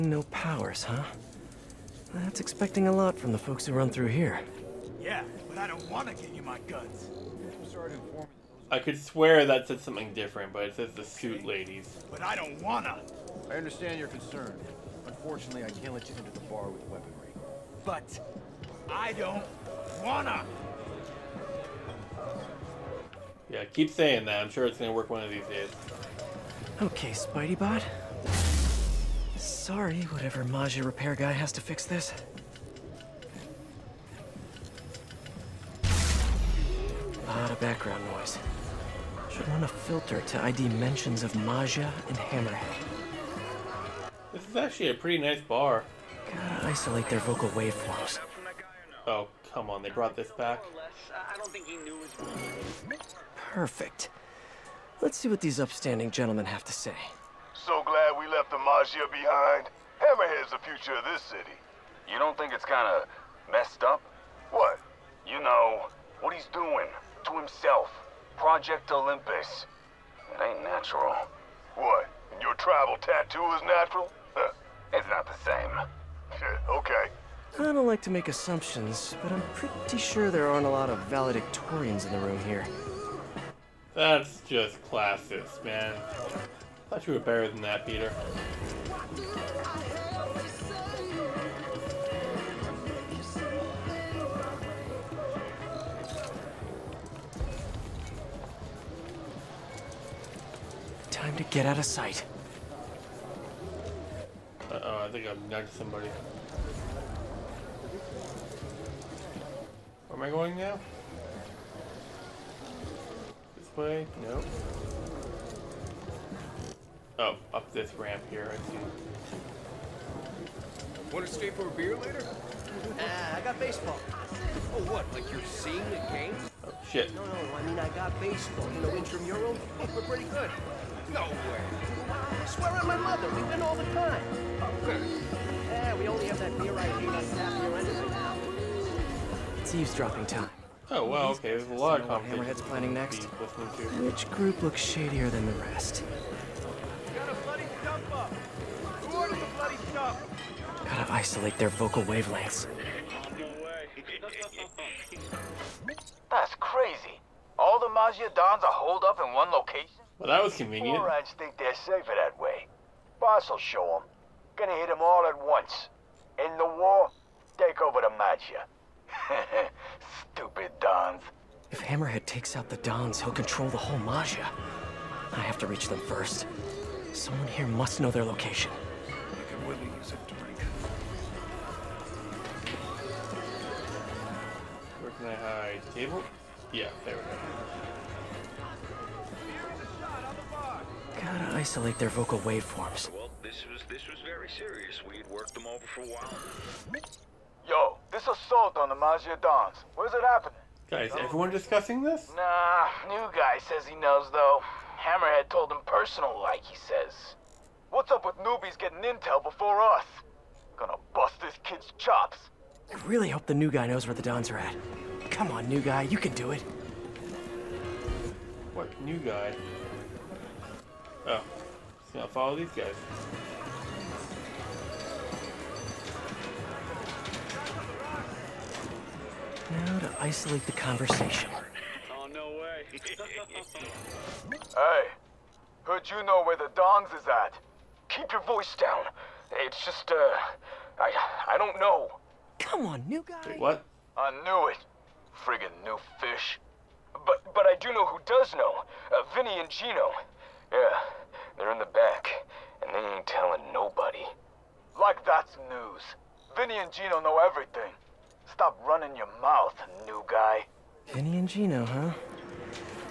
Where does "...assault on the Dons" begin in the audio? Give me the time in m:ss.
3:18.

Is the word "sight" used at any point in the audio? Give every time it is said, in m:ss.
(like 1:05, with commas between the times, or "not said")
1:41.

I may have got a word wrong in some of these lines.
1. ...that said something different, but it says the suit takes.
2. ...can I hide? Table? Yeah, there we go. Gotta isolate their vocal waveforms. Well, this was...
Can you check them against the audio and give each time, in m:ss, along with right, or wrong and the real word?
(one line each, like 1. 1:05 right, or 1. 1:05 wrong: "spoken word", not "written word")
1. 0:09 wrong: "ladies", not "takes"
2. 3:05 right.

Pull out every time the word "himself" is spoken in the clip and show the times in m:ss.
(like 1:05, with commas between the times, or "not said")
1:07.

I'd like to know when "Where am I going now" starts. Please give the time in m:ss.
1:50.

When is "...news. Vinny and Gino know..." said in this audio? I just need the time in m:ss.
4:15.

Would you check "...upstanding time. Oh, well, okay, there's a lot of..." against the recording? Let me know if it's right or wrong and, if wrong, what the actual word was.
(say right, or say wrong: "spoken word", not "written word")
wrong: "eavesdropping", not "upstanding".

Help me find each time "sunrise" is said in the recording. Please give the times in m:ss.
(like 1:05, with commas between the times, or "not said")
not said.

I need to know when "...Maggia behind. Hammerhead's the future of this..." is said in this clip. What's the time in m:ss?
0:58.